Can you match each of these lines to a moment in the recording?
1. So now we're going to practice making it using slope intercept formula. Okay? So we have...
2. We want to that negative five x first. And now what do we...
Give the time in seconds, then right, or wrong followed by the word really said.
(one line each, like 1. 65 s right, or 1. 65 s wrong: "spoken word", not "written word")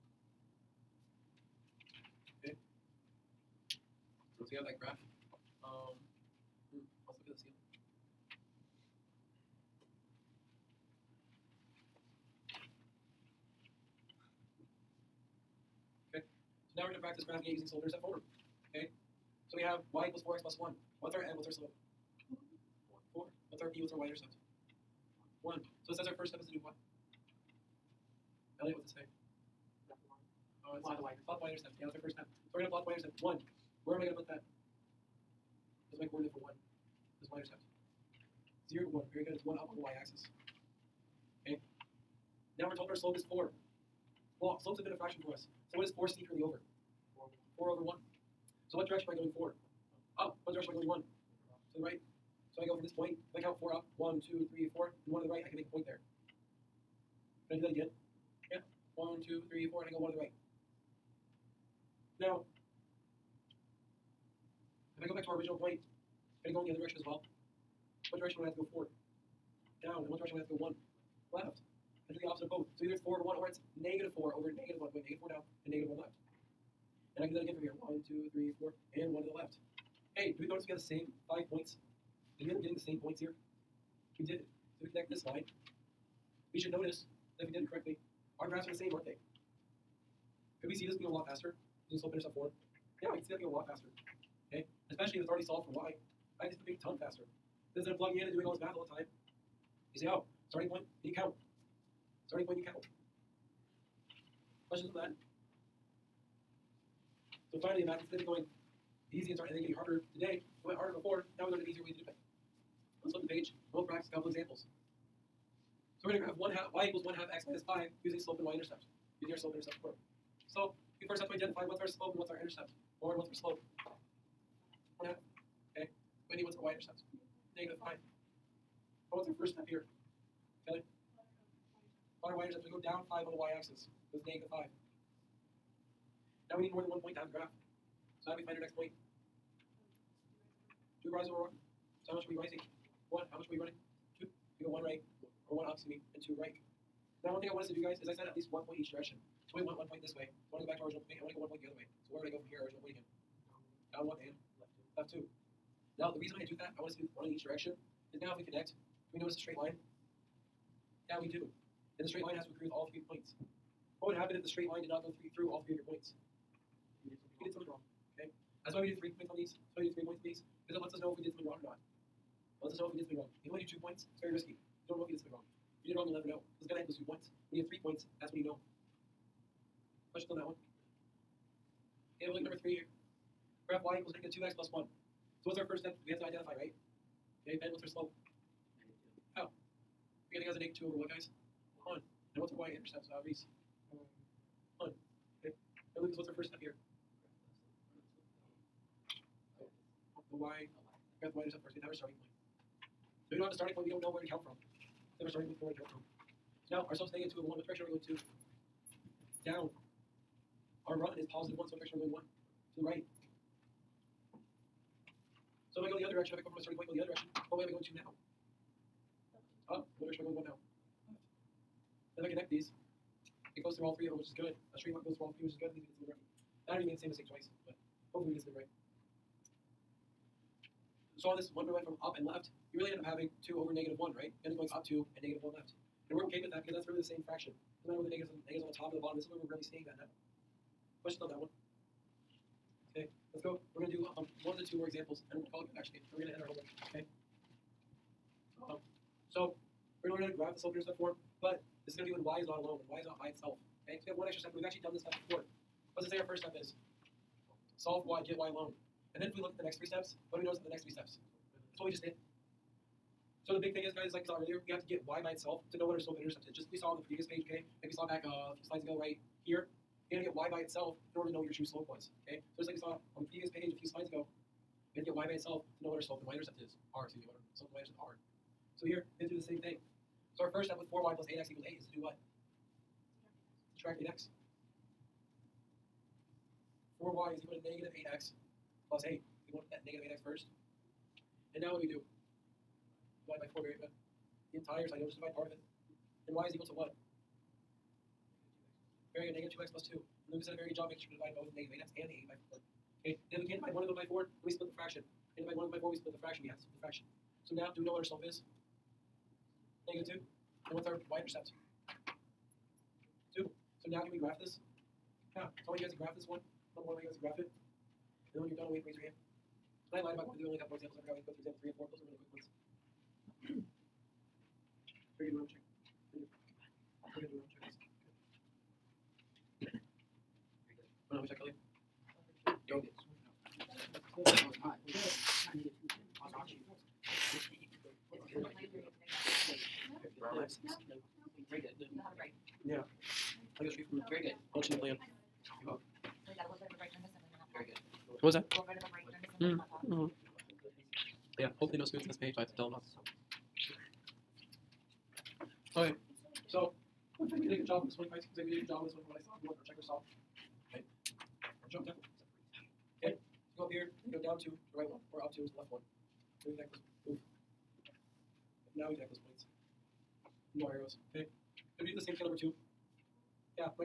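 1. 16 s wrong: "graphing", not "making"
2. 289 s wrong: "eight", not "five".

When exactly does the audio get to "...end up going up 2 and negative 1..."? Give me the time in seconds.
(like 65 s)
234 s.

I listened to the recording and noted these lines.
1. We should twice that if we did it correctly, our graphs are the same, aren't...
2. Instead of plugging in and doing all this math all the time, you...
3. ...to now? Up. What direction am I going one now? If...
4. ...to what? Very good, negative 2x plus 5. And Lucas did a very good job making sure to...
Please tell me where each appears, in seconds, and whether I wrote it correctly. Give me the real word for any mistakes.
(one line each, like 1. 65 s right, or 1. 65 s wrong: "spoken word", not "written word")
1. 86 s wrong: "notice", not "twice"
2. 97 s right
3. 217 s right
4. 296 s wrong: "2", not "5".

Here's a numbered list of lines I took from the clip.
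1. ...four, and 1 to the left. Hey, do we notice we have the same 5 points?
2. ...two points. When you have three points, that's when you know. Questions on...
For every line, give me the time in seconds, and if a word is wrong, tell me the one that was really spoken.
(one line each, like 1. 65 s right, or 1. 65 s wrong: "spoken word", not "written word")
1. 78 s right
2. 176 s right.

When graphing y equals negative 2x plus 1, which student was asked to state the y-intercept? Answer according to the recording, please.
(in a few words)
Reese.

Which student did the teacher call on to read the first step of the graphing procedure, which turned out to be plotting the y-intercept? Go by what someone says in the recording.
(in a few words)
Elliot.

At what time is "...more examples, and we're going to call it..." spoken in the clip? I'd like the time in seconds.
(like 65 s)
244 s.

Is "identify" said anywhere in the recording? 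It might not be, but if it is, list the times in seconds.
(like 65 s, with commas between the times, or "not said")
121 s, 186 s.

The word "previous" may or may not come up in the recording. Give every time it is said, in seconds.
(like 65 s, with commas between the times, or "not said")
267 s, 273 s.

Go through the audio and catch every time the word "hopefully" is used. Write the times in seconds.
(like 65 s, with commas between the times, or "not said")
228 s, 351 s.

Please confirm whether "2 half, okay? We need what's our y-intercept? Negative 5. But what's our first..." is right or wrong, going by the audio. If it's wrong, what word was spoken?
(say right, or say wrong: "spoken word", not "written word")
wrong: "1", not "2".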